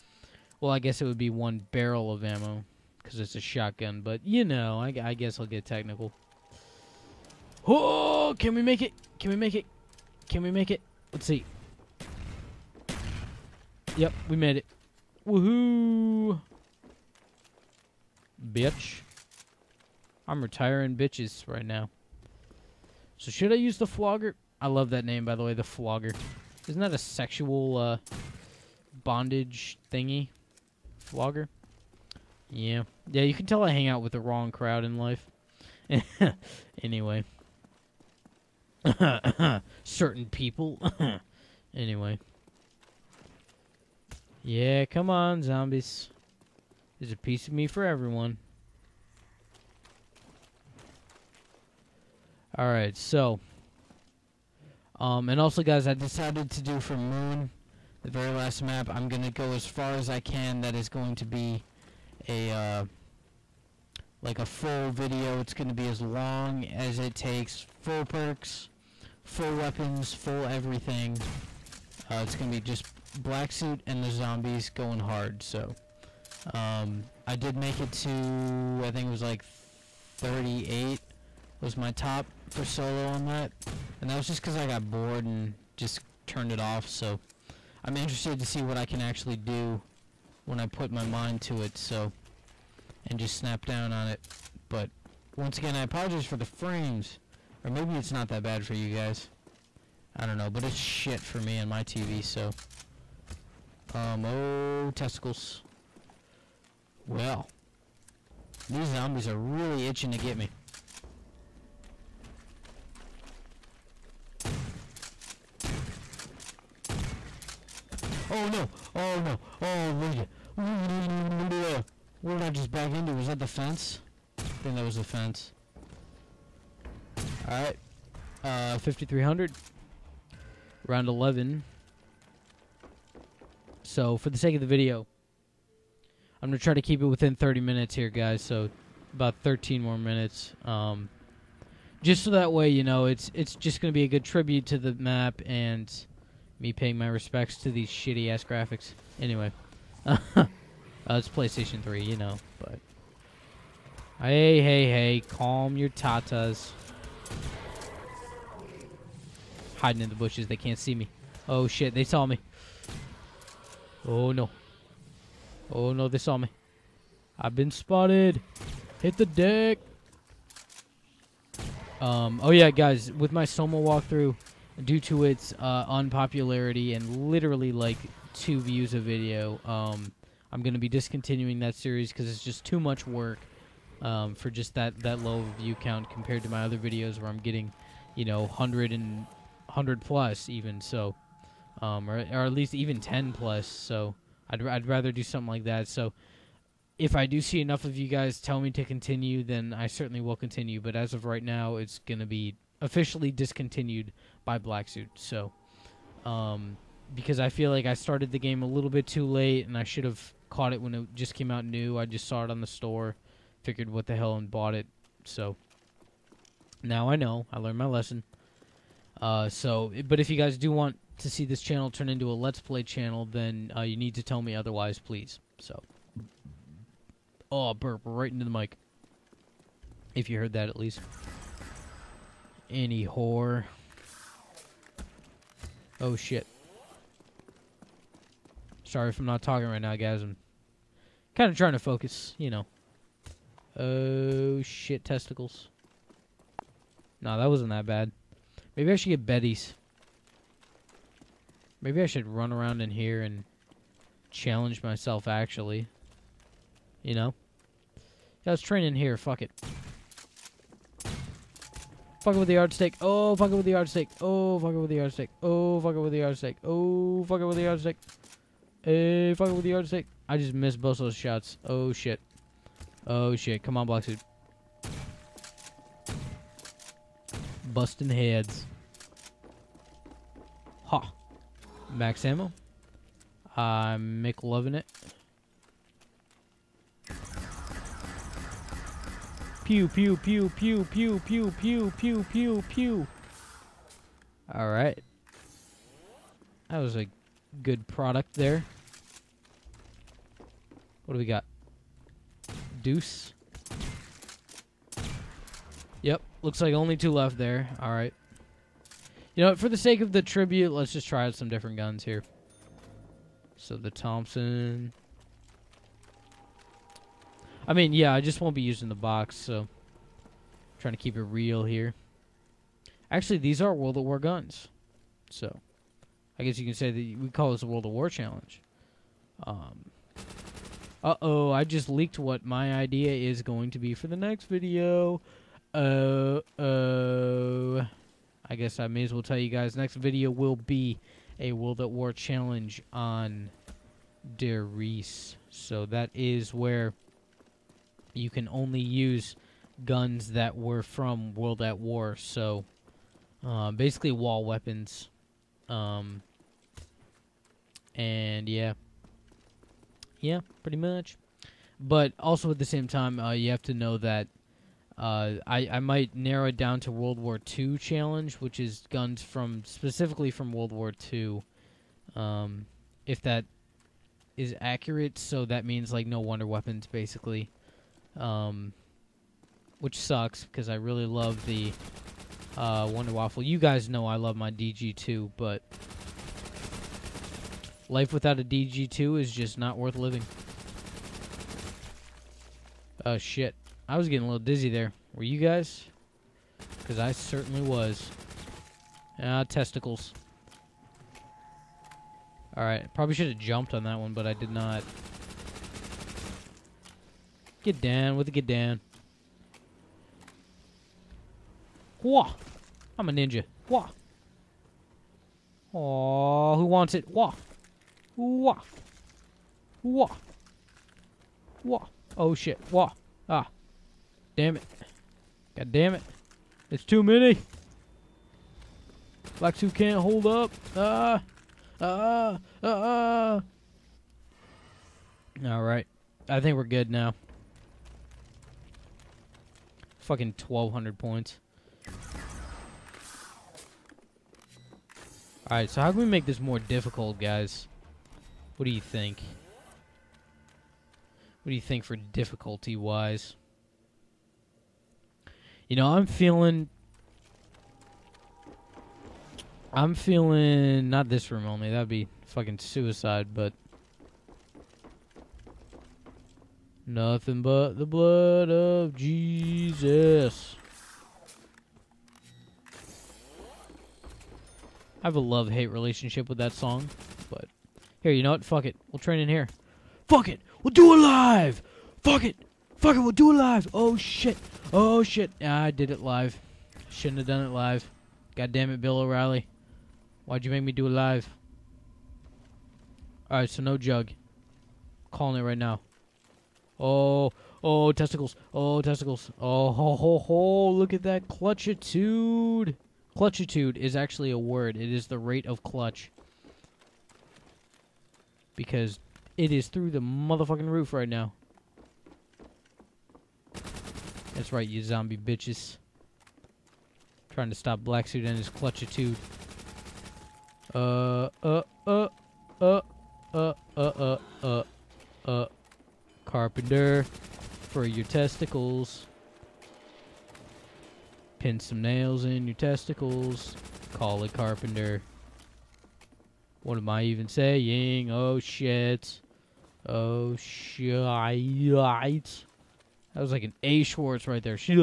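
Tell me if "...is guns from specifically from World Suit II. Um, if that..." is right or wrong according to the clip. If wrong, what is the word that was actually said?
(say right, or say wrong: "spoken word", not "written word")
wrong: "War", not "Suit".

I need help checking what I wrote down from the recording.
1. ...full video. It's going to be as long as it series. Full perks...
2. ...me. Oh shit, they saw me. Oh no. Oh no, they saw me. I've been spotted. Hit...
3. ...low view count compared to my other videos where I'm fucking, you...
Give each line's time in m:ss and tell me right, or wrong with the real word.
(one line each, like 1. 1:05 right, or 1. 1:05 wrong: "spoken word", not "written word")
1. 1:04 wrong: "takes", not "series"
2. 2:40 right
3. 3:05 wrong: "getting", not "fucking".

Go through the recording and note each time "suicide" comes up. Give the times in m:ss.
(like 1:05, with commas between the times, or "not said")
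7:42.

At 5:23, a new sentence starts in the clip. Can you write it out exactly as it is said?
Actually, these are World of War guns.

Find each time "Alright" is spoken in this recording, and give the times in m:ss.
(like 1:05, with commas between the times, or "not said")
0:52, 2:07, 4:54, 6:42, 7:25, 8:13.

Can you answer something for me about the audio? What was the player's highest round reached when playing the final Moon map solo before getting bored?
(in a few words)
38.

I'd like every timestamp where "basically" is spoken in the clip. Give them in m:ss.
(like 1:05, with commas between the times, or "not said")
5:53, 6:16.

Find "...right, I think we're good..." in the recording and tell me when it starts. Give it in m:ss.
7:15.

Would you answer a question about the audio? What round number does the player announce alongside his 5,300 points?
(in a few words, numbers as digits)
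Round 11.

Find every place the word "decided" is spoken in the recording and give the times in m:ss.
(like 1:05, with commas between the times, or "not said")
0:55.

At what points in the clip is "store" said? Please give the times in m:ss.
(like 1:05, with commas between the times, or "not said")
3:32.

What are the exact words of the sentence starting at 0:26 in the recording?
Isn't that a sexual uh, bondage thingy?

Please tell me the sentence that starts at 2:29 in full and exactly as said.
Anyway uh, it's PlayStation 3, you know, but.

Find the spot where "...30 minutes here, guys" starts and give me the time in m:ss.
2:17.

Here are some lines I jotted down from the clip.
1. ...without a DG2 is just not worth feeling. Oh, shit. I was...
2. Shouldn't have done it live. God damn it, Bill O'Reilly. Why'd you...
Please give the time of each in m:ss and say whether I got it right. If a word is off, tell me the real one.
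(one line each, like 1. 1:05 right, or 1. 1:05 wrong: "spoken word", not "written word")
1. 6:28 wrong: "living", not "feeling"
2. 8:06 right.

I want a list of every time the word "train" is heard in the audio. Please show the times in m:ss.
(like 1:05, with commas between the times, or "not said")
4:18, 7:58.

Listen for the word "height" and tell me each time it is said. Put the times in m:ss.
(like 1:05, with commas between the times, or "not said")
not said.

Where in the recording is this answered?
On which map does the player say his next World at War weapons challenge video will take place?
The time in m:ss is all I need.
5:44.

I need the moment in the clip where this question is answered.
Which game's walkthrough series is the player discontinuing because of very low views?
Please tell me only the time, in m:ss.
2:53.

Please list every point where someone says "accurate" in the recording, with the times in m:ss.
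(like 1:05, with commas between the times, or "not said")
6:14.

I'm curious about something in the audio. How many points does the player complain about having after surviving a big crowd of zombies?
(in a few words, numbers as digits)
1200.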